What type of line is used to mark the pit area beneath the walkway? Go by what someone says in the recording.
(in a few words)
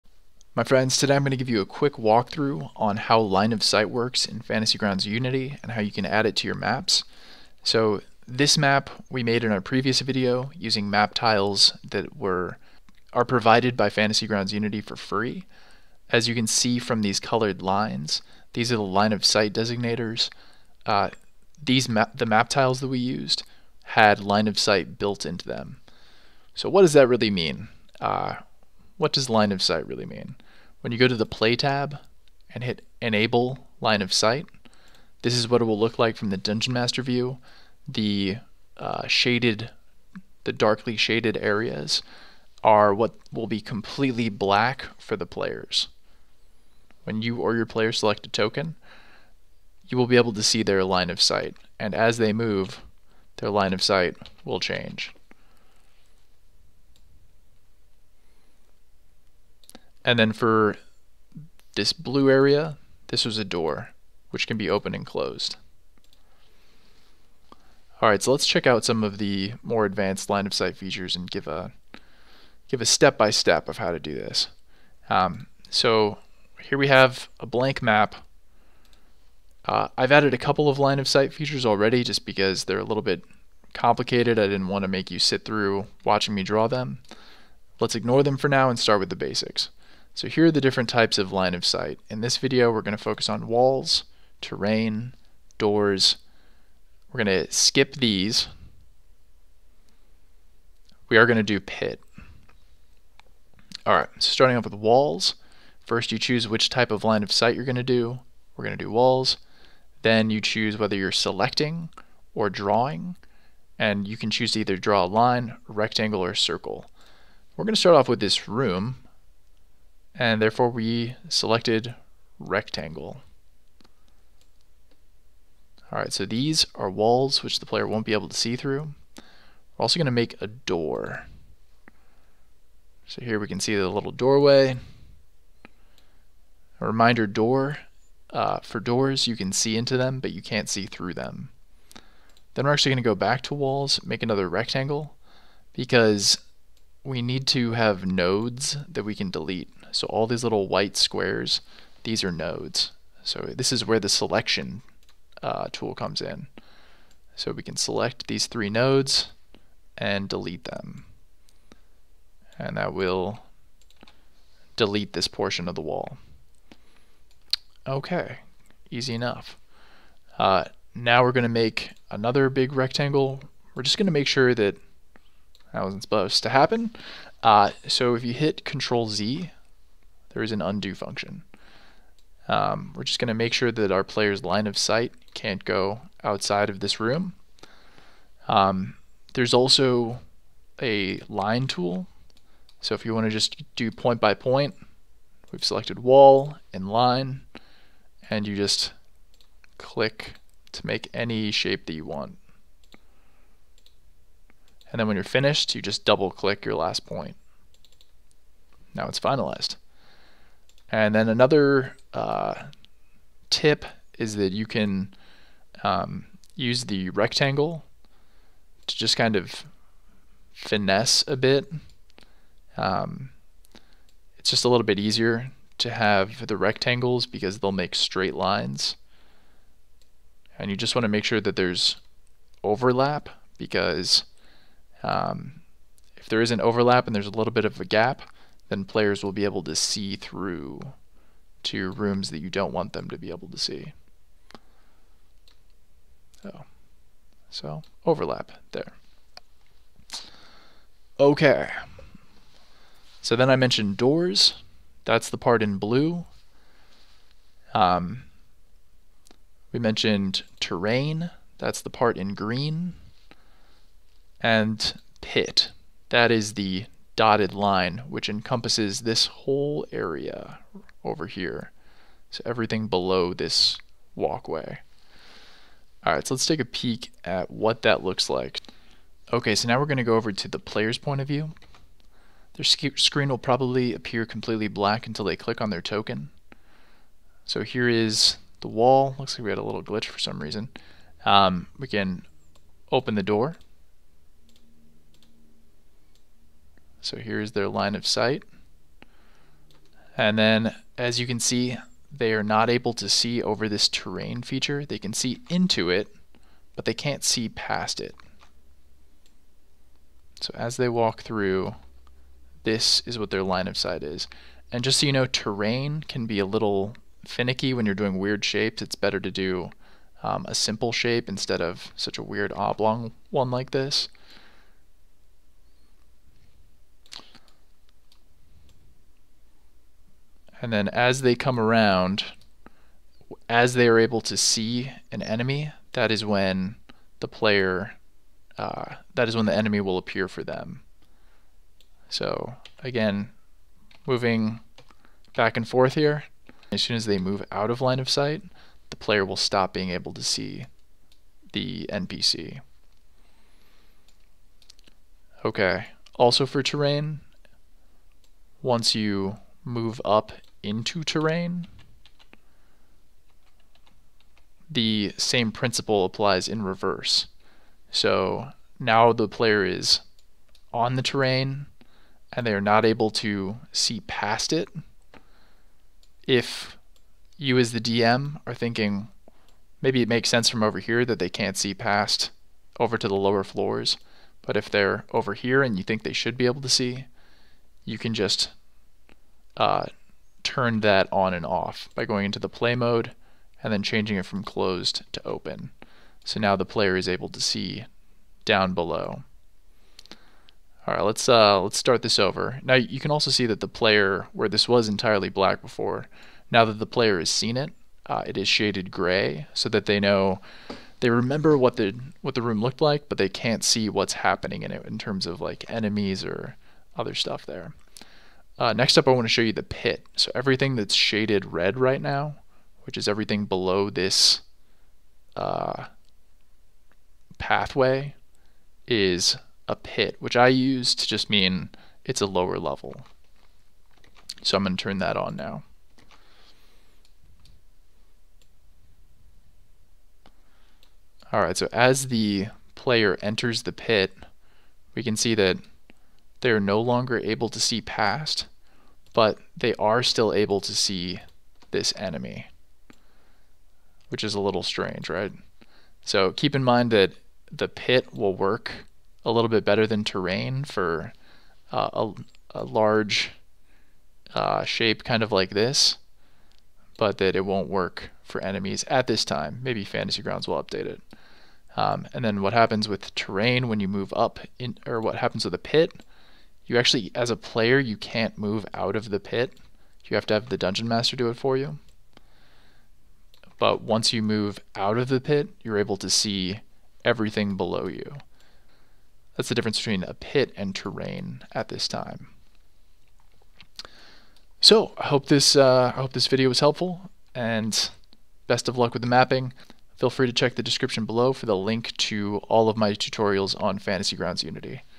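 Dotted line.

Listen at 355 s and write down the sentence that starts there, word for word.
Okay, also for terrain, once you move up into terrain.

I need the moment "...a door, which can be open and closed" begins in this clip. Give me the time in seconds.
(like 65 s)
63 s.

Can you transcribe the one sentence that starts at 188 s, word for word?
Um, there's also a line tool.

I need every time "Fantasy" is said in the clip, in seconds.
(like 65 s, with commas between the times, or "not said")
4 s, 13 s, 469 s, 503 s.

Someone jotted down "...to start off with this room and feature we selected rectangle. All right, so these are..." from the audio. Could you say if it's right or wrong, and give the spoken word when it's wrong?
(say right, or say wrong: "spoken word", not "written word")
wrong: "therefore", not "feature".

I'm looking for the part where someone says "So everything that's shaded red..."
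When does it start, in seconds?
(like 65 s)
420 s.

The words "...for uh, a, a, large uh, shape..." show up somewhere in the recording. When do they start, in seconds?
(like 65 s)
460 s.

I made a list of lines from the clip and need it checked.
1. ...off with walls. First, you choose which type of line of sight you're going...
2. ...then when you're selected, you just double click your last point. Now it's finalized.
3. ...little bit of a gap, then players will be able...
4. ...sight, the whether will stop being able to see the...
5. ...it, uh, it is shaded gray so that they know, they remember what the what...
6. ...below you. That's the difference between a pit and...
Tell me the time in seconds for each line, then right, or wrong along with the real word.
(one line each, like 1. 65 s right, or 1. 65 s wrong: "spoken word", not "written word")
1. 104 s right
2. 204 s wrong: "finished", not "selected"
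3. 237 s right
4. 348 s wrong: "player", not "whether"
5. 407 s right
6. 487 s right.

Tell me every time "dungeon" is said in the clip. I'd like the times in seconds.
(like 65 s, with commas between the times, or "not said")
36 s, 480 s.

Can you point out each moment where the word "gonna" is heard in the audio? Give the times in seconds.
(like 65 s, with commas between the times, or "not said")
279 s.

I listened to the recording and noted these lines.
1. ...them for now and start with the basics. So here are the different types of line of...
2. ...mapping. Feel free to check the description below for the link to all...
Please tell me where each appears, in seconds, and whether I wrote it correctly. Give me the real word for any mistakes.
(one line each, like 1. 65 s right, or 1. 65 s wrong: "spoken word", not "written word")
1. 88 s right
2. 499 s right.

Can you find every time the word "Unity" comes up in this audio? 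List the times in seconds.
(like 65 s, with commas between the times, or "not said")
5 s, 14 s, 504 s.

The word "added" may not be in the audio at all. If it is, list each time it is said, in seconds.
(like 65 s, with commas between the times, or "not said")
80 s.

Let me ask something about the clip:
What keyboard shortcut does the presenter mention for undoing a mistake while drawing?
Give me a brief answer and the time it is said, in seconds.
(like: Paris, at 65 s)
Control Z, at 178 s.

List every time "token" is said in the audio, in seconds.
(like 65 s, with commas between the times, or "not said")
48 s, 285 s.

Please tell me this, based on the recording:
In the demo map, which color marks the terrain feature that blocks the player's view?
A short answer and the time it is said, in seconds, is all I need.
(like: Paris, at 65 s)
Green, at 262 s.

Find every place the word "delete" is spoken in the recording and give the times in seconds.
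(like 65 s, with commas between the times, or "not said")
149 s, 160 s, 164 s.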